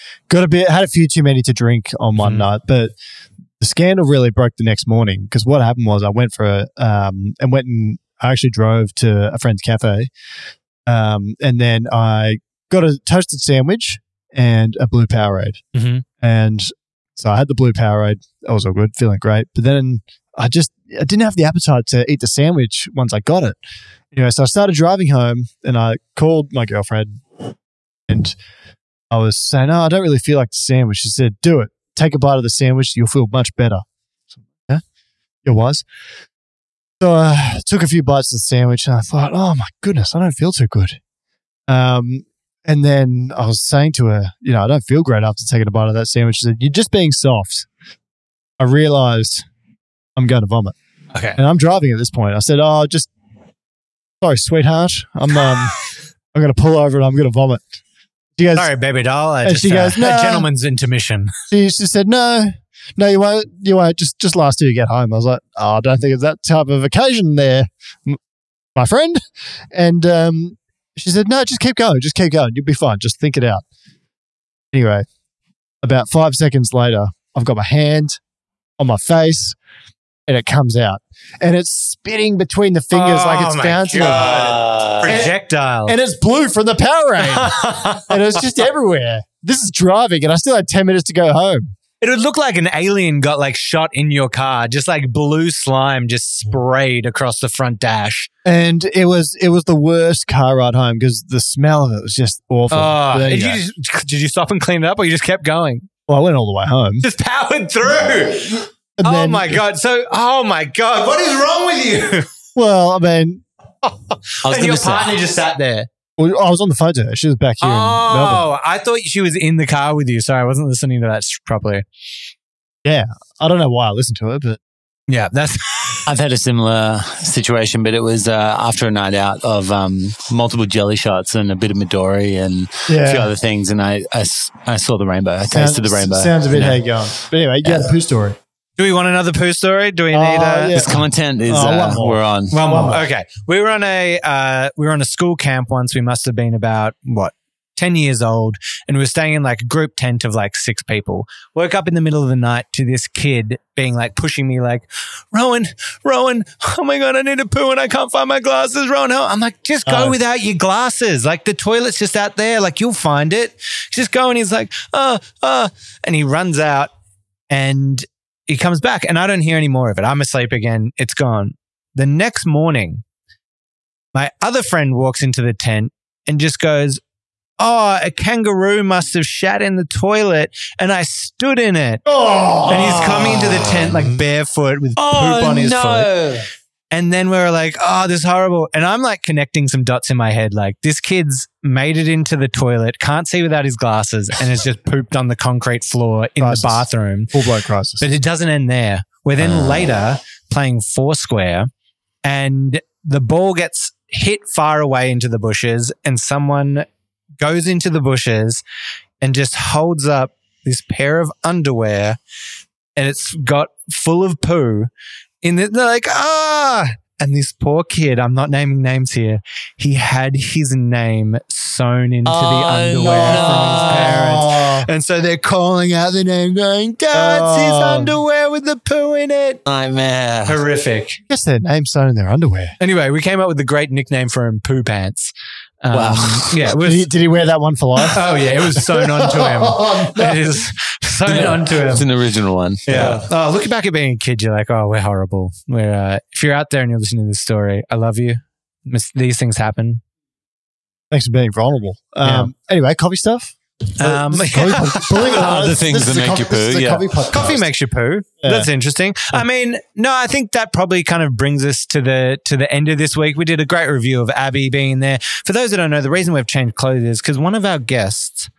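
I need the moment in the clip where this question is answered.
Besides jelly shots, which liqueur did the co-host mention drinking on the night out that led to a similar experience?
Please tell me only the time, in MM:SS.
02:11.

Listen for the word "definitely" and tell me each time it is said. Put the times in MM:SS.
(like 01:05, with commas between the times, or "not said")
not said.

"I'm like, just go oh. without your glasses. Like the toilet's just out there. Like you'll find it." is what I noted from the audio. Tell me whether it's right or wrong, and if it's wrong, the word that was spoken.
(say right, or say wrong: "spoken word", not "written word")
right.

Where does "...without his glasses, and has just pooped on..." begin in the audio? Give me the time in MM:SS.
03:13.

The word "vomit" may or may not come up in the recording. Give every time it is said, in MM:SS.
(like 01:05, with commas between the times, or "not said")
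00:50, 00:57.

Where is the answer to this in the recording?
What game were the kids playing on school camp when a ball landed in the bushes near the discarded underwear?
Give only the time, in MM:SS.
03:20.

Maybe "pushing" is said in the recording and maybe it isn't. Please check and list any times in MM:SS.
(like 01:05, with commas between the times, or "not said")
02:34.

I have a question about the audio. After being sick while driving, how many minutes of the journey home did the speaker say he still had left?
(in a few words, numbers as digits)
10.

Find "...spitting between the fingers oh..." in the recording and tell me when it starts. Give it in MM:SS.
01:21.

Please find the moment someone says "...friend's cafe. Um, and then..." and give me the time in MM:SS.
00:09.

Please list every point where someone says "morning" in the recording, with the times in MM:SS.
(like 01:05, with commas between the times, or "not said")
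00:04, 02:52.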